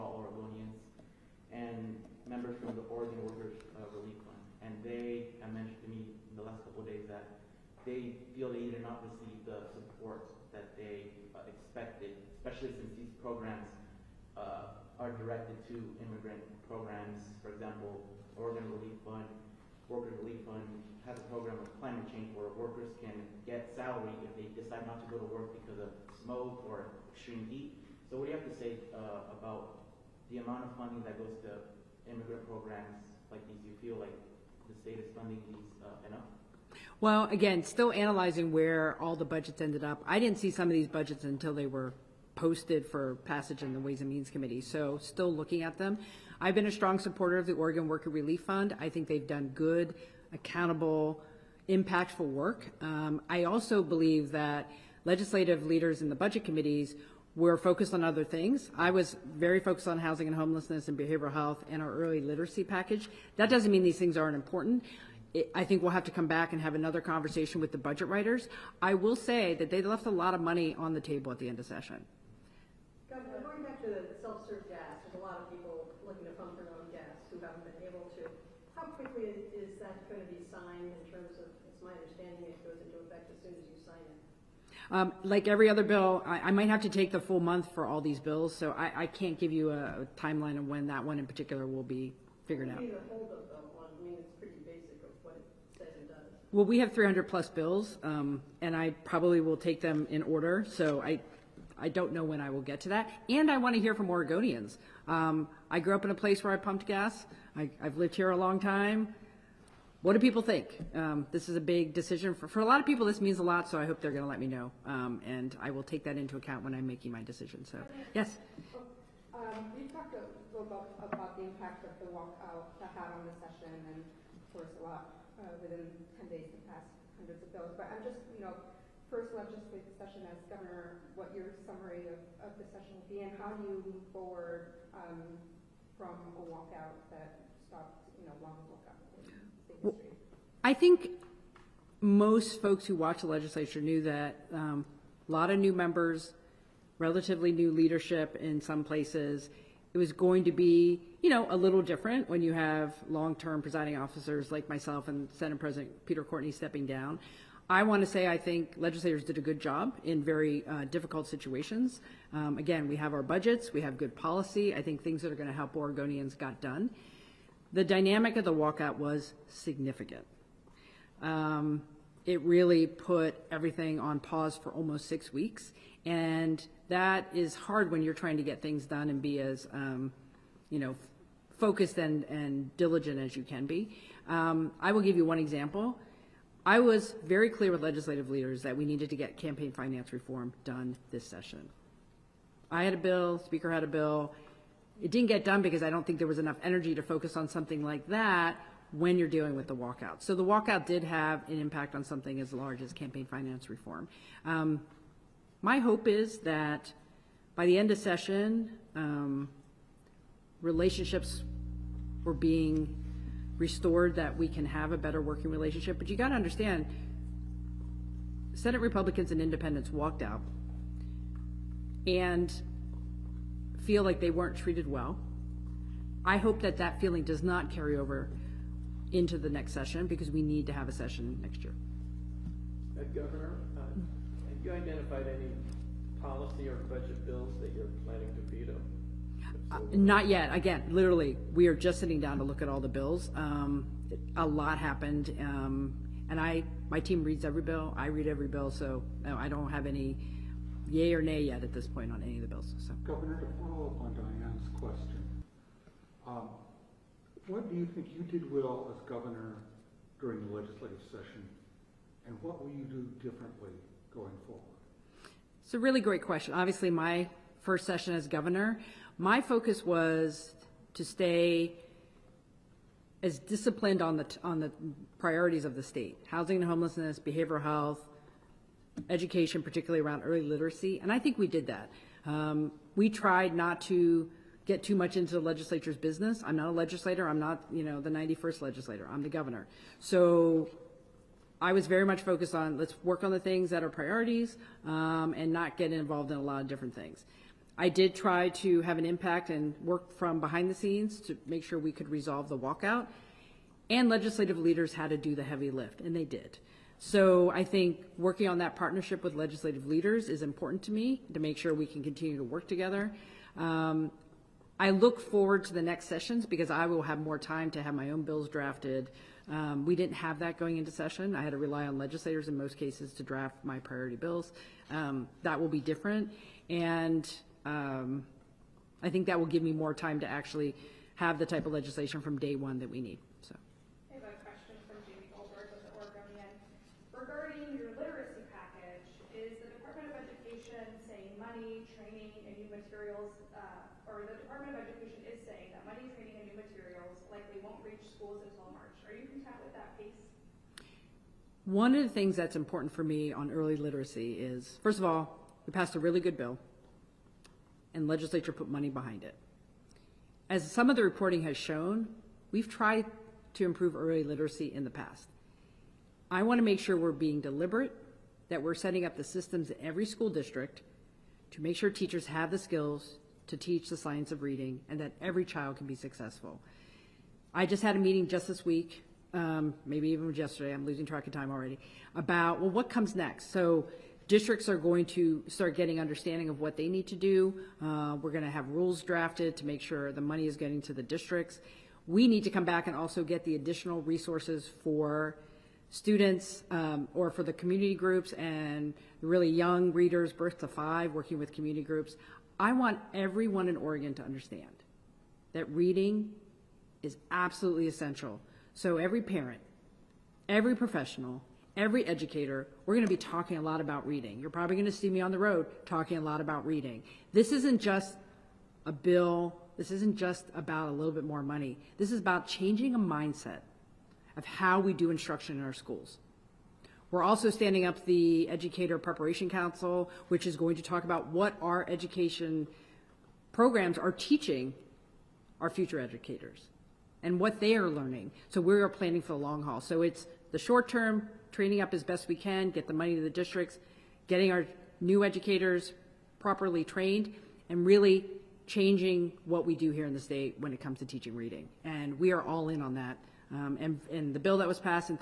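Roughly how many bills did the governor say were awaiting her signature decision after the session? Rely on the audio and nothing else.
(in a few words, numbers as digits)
300 plus.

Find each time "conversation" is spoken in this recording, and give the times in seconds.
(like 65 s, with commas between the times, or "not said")
67 s.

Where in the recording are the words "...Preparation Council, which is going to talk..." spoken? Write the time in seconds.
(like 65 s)
428 s.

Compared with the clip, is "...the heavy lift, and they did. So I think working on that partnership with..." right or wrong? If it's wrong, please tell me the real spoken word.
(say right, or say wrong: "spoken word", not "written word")
right.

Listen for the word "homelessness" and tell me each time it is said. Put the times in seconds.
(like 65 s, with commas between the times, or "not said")
60 s, 276 s.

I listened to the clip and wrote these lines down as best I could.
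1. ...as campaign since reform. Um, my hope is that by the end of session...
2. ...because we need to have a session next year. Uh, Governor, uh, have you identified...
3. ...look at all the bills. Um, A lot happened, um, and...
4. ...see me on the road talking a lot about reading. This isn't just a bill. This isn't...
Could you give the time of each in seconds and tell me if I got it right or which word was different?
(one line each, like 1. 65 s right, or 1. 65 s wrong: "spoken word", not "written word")
1. 202 s wrong: "finance", not "since"
2. 230 s right
3. 242 s right
4. 414 s right.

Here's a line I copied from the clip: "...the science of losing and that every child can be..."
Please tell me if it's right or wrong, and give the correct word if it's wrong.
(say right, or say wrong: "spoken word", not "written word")
wrong: "reading", not "losing".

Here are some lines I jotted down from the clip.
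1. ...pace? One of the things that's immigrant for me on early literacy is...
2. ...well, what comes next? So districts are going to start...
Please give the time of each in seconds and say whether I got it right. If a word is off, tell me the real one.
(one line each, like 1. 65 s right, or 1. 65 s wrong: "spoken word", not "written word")
1. 349 s wrong: "important", not "immigrant"
2. 382 s right.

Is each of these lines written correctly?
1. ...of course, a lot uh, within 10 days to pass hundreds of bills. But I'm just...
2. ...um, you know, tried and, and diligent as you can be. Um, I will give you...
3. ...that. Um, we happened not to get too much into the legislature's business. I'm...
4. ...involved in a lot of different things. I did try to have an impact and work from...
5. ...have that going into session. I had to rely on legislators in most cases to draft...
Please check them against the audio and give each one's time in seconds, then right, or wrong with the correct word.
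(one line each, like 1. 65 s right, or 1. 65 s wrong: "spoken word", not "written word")
1. 124 s right
2. 179 s wrong: "focused", not "tried"
3. 281 s wrong: "tried", not "happened"
4. 295 s right
5. 320 s right.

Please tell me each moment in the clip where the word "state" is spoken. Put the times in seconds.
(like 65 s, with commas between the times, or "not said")
34 s, 275 s, 450 s.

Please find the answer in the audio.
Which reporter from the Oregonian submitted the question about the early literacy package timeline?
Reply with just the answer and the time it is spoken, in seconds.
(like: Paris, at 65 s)
Jamie Goldberg, at 335 s.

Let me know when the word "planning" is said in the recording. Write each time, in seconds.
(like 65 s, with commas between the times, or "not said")
238 s, 438 s.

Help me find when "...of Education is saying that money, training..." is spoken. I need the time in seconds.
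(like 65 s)
344 s.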